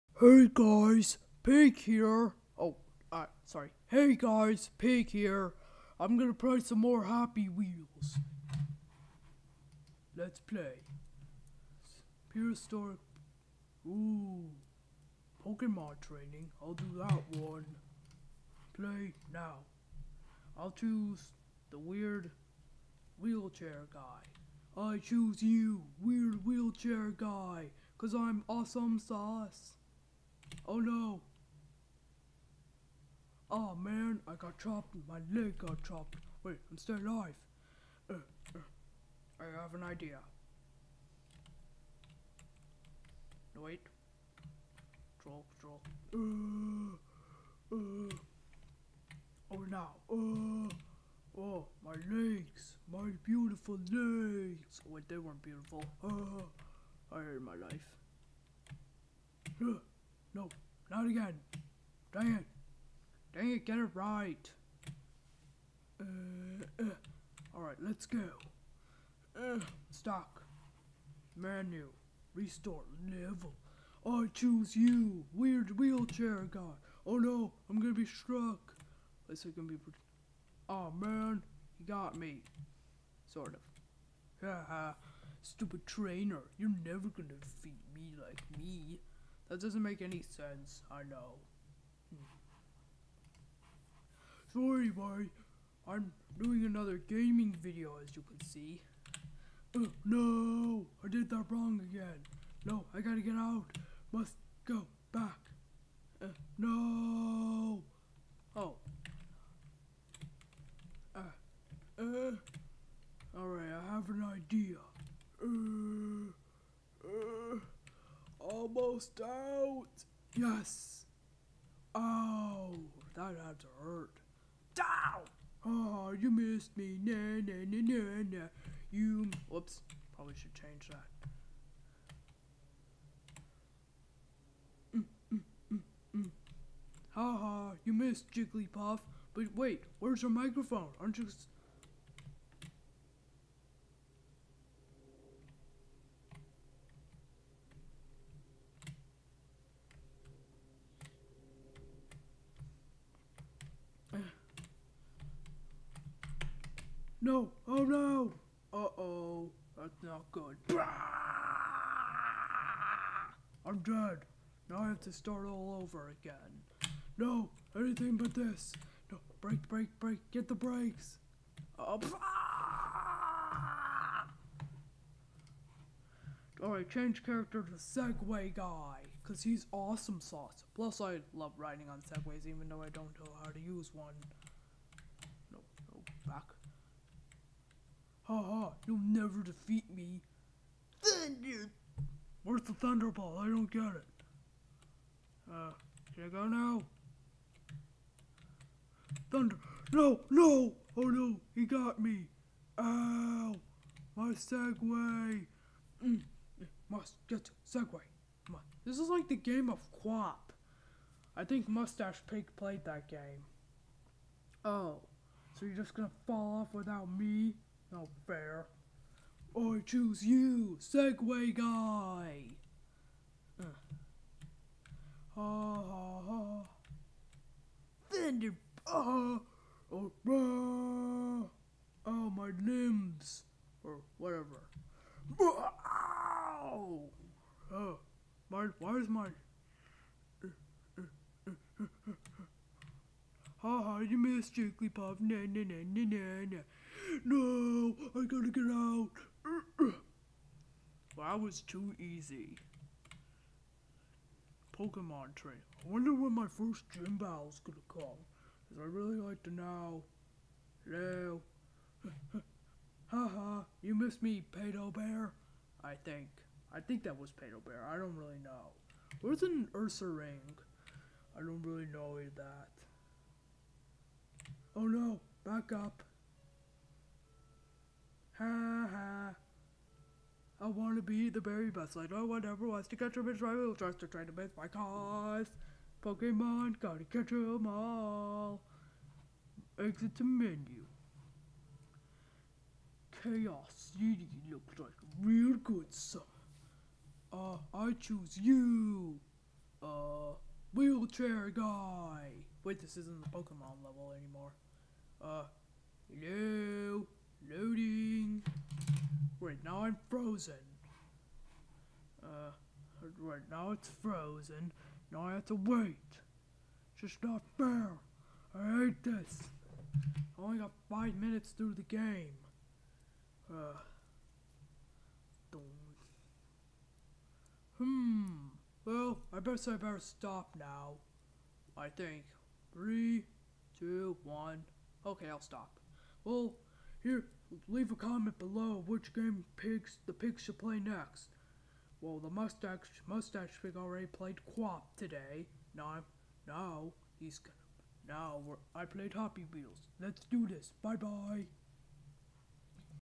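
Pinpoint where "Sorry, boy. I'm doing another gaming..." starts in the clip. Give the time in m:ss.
1:34.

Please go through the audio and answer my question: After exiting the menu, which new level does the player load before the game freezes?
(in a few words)
Chaos City.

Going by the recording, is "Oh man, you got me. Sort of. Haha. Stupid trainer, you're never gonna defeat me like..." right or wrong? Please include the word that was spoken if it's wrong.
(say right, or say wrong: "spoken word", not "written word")
right.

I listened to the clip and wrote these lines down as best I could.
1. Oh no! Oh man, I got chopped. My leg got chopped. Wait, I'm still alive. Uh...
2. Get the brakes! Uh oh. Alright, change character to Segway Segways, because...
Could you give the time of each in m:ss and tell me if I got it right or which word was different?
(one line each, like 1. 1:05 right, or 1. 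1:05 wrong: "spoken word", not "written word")
1. 0:30 right
2. 2:50 wrong: "Guy", not "Segways".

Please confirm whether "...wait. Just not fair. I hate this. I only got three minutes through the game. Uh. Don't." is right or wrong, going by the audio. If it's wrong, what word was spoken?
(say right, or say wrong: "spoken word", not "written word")
wrong: "five", not "three".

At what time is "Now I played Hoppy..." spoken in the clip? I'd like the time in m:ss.
5:48.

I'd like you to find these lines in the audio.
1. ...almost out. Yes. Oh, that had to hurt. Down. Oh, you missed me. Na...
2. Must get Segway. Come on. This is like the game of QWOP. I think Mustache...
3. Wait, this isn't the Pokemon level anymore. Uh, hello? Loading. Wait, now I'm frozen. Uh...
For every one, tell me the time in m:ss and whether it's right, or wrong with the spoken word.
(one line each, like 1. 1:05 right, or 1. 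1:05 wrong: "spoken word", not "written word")
1. 1:58 right
2. 3:26 right
3. 5:02 right.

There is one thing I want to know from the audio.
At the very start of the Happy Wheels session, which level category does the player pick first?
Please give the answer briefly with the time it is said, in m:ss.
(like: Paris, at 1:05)
Prehistoric, at 0:12.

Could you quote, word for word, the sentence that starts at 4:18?
Cause I really like to know.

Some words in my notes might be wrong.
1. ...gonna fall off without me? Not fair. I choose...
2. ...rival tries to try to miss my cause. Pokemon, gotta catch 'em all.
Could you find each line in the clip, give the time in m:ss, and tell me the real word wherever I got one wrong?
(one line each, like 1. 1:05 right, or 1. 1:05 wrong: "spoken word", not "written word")
1. 3:35 right
2. 4:43 right.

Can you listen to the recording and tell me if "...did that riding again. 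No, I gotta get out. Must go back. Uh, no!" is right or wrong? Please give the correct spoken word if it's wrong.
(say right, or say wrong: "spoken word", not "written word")
wrong: "wrong", not "riding".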